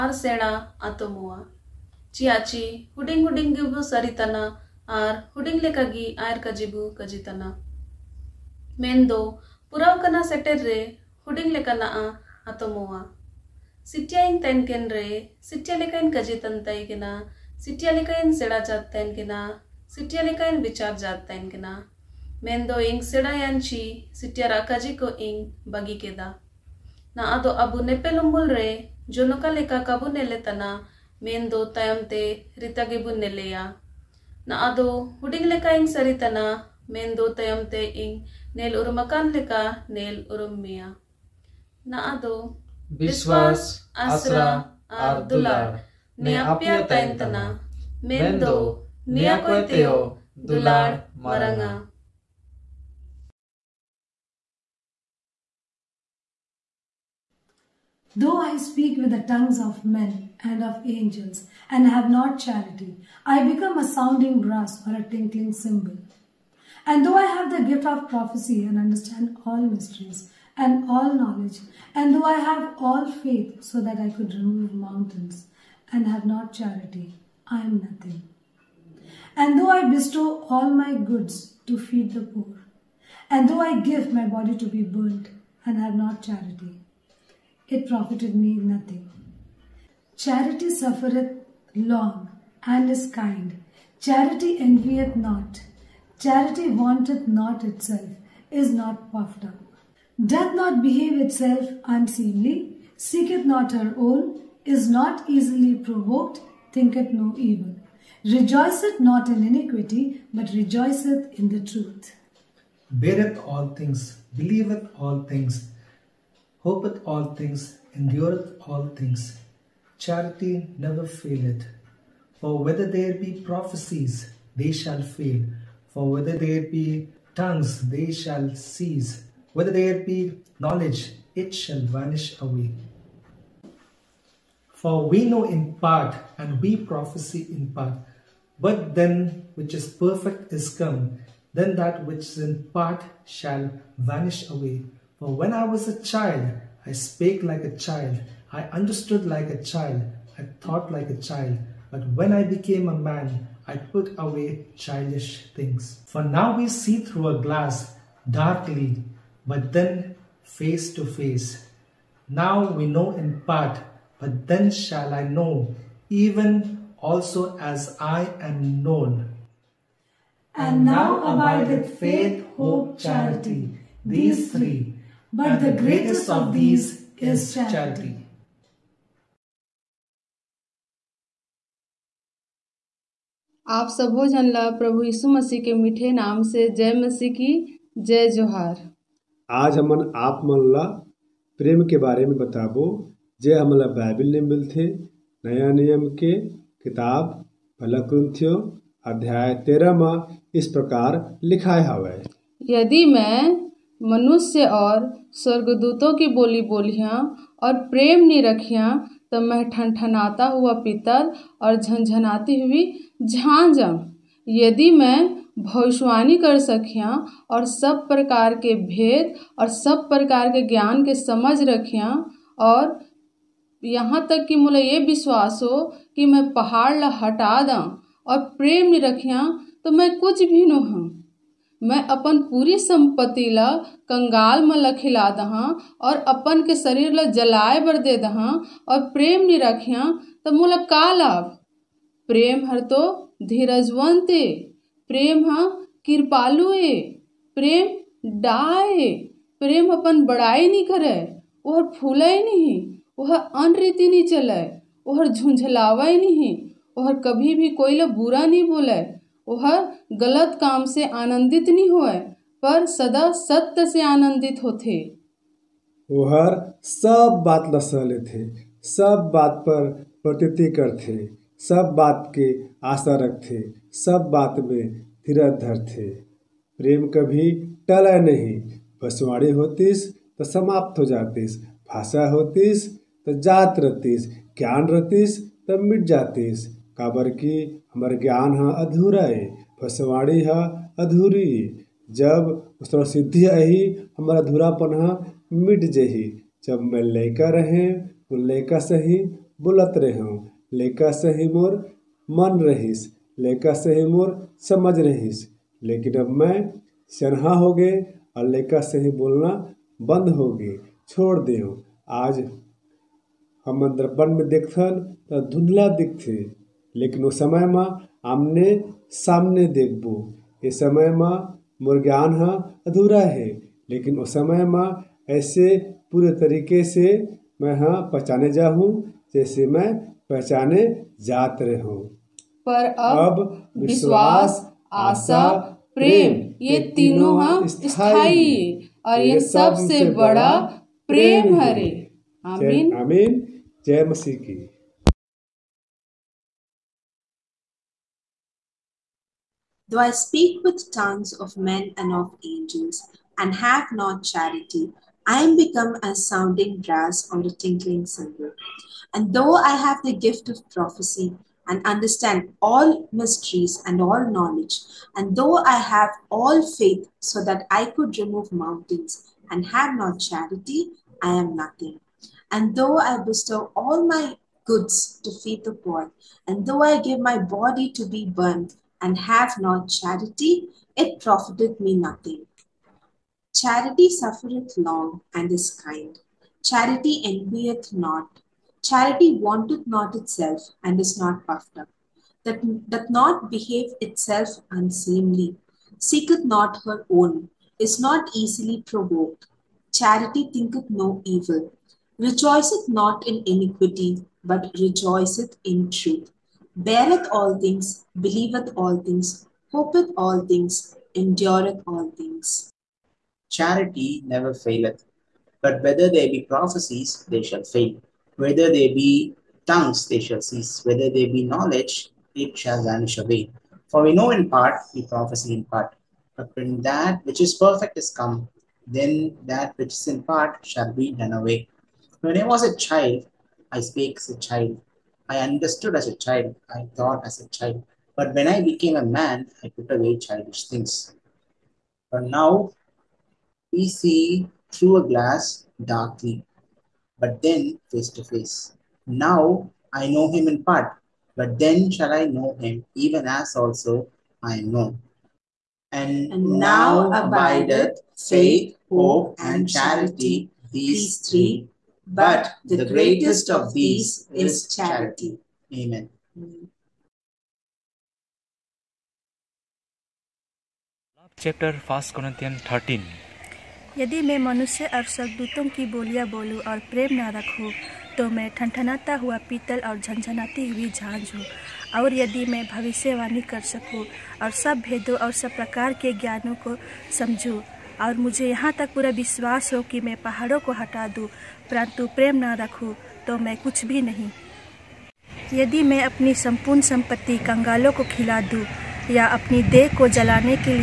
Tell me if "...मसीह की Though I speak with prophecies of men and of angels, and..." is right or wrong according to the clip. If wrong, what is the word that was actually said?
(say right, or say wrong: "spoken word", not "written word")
wrong: "tongues", not "prophecies".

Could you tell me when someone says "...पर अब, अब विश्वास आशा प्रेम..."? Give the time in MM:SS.
05:32.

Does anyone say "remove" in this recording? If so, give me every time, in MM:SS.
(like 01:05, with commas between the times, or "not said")
01:14, 06:08.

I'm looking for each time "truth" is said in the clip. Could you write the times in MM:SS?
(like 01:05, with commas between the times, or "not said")
01:51, 06:45.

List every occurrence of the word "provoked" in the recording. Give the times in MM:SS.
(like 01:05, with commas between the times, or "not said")
01:45, 06:38.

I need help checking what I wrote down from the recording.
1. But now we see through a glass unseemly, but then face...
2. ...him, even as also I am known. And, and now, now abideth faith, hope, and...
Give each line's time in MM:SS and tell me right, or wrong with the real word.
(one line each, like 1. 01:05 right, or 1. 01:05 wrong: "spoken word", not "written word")
1. 07:22 wrong: "darkly", not "unseemly"
2. 07:32 right.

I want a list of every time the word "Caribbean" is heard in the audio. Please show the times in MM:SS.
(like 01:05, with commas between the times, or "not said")
not said.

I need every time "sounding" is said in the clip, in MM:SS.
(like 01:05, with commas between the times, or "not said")
01:03, 05:56.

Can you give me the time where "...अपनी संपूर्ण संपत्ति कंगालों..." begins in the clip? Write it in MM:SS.
08:16.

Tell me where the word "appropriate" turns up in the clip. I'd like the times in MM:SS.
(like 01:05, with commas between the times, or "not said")
not said.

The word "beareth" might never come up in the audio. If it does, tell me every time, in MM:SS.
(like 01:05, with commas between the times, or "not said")
01:52, 06:46.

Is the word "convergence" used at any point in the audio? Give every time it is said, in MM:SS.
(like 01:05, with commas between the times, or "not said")
not said.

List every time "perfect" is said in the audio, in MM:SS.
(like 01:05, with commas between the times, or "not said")
02:19, 07:07.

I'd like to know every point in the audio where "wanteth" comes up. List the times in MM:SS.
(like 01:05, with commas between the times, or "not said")
01:36, 06:29.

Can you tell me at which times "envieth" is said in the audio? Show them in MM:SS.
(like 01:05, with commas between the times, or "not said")
01:34, 06:27.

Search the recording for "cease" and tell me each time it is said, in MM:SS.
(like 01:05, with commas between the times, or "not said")
02:08, 07:00.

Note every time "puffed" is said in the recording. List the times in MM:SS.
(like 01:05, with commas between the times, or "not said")
01:39, 06:31.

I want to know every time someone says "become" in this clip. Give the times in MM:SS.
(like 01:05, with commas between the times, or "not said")
01:03, 05:55.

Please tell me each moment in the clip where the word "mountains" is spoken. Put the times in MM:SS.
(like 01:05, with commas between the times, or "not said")
01:14, 06:08.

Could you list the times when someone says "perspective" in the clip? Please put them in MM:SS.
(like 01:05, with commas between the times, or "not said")
not said.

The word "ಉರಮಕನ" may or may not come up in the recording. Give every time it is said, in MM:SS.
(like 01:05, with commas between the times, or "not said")
00:38.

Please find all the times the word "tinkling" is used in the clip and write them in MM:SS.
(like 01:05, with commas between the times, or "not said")
01:05, 05:57.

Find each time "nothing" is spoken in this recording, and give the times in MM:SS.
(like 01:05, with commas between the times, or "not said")
01:17, 01:28, 06:11, 06:21.